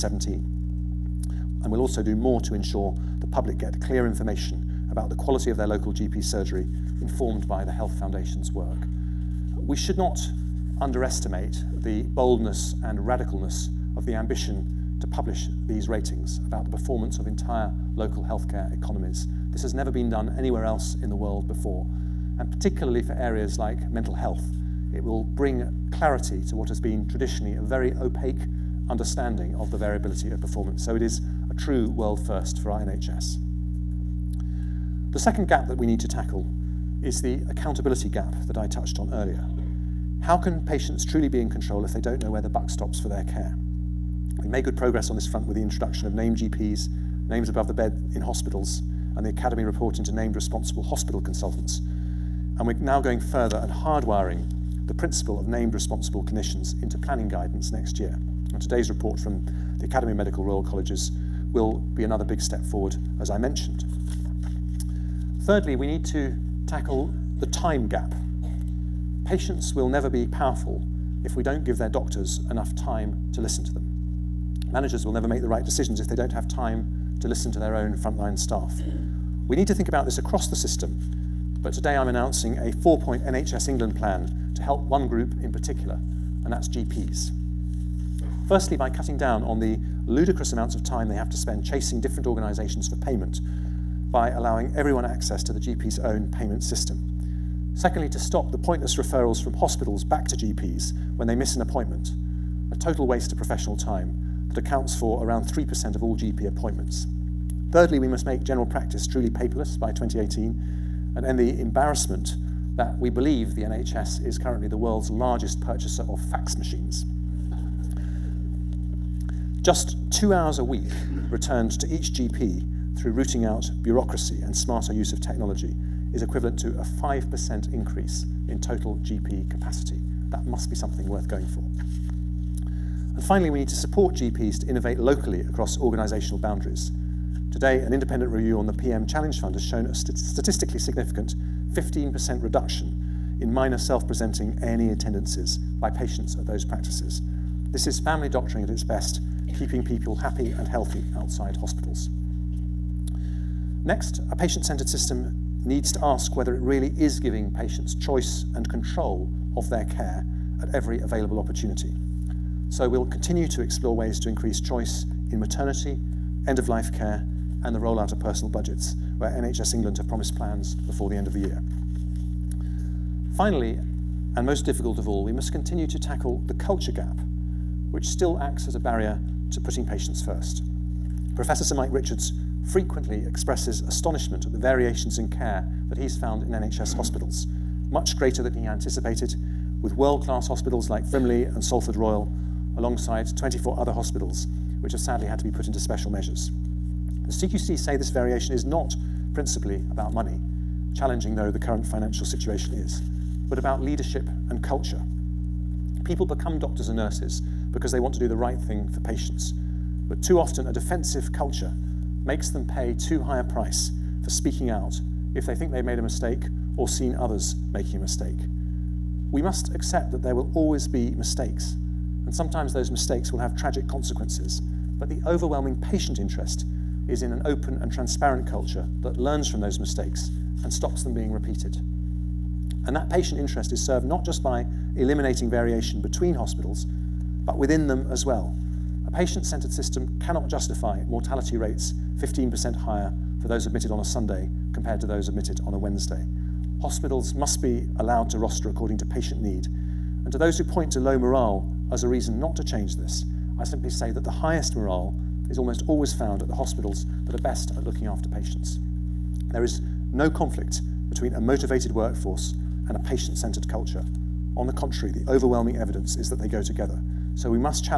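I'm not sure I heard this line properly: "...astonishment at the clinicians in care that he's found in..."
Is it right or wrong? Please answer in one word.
wrong.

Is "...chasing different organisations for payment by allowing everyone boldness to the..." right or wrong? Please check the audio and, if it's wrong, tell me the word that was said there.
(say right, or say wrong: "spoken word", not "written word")
wrong: "access", not "boldness".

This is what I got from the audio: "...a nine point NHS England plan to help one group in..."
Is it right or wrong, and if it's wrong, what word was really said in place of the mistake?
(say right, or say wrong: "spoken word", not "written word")
wrong: "four", not "nine".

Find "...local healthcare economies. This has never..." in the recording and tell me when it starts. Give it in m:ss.
0:17.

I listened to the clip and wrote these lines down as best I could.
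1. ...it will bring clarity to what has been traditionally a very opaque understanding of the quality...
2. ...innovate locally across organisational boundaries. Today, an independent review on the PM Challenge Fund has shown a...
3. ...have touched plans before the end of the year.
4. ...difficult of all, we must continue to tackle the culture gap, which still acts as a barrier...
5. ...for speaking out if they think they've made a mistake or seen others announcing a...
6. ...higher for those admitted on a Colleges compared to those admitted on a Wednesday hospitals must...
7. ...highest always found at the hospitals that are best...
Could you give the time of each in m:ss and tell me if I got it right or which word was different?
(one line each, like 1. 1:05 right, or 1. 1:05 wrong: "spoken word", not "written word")
1. 0:24 wrong: "variability", not "quality"
2. 2:14 right
3. 2:49 wrong: "promised", not "touched"
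4. 2:54 right
5. 3:34 wrong: "making", not "announcing"
6. 4:02 wrong: "Sunday", not "Colleges"
7. 4:15 wrong: "almost", not "highest".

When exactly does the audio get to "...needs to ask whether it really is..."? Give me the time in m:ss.
2:35.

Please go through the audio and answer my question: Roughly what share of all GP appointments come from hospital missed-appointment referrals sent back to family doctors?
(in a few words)
3%.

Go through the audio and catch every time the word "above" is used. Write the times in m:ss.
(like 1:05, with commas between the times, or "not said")
0:47.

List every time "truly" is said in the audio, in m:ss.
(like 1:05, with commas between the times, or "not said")
0:41, 1:49.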